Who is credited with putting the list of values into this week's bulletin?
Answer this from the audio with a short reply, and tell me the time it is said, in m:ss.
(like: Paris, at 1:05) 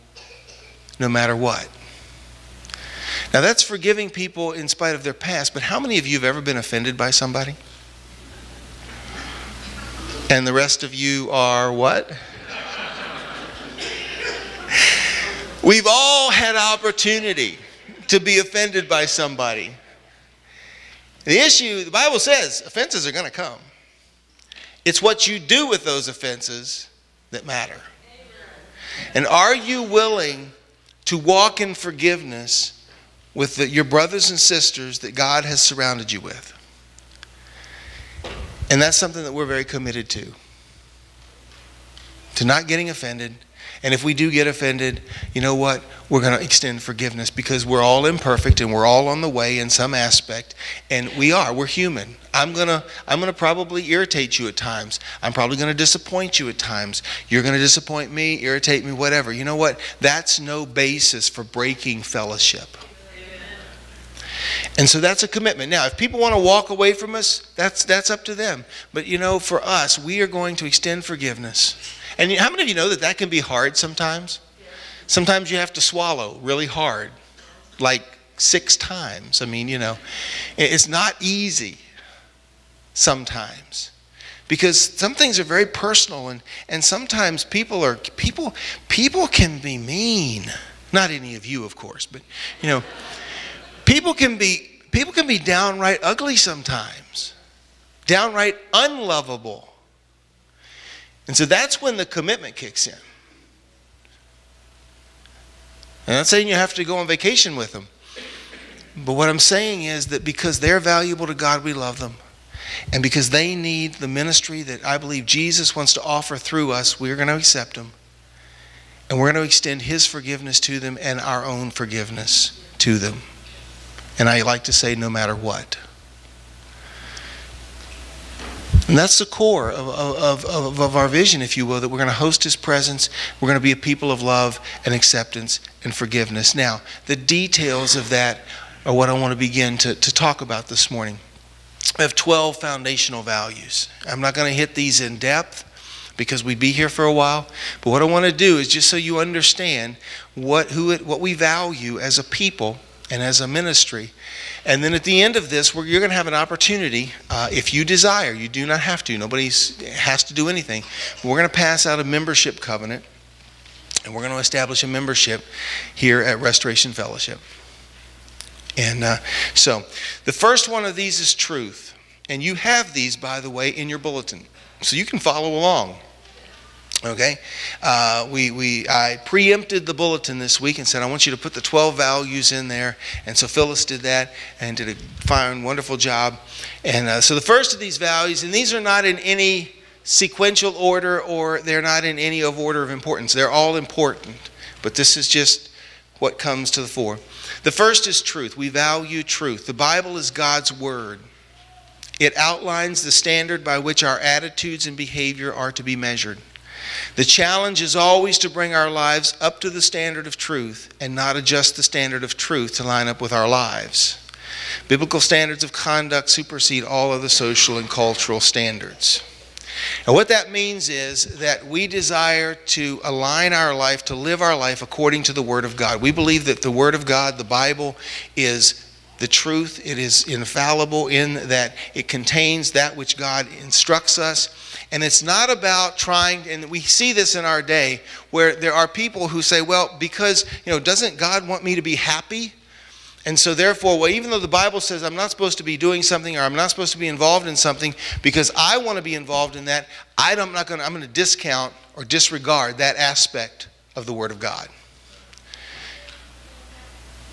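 Phyllis, at 3:03.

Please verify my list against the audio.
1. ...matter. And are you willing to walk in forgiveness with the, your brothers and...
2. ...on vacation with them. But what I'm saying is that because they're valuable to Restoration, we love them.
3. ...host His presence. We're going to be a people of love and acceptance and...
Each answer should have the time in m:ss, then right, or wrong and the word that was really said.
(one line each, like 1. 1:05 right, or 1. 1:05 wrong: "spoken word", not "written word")
1. 0:27 right
2. 1:46 wrong: "God", not "Restoration"
3. 2:12 right.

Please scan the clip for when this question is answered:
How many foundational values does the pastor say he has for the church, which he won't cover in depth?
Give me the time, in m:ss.
2:22.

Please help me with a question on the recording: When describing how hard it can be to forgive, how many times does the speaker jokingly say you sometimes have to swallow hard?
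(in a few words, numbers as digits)
6.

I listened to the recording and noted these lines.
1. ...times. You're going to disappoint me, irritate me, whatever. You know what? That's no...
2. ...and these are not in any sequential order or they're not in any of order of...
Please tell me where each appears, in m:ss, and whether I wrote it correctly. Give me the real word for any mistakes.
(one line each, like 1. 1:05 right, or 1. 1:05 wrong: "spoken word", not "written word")
1. 0:56 right
2. 3:08 right.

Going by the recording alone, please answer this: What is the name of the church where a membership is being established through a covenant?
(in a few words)
Restoration Fellowship.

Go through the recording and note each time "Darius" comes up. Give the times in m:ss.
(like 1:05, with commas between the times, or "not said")
not said.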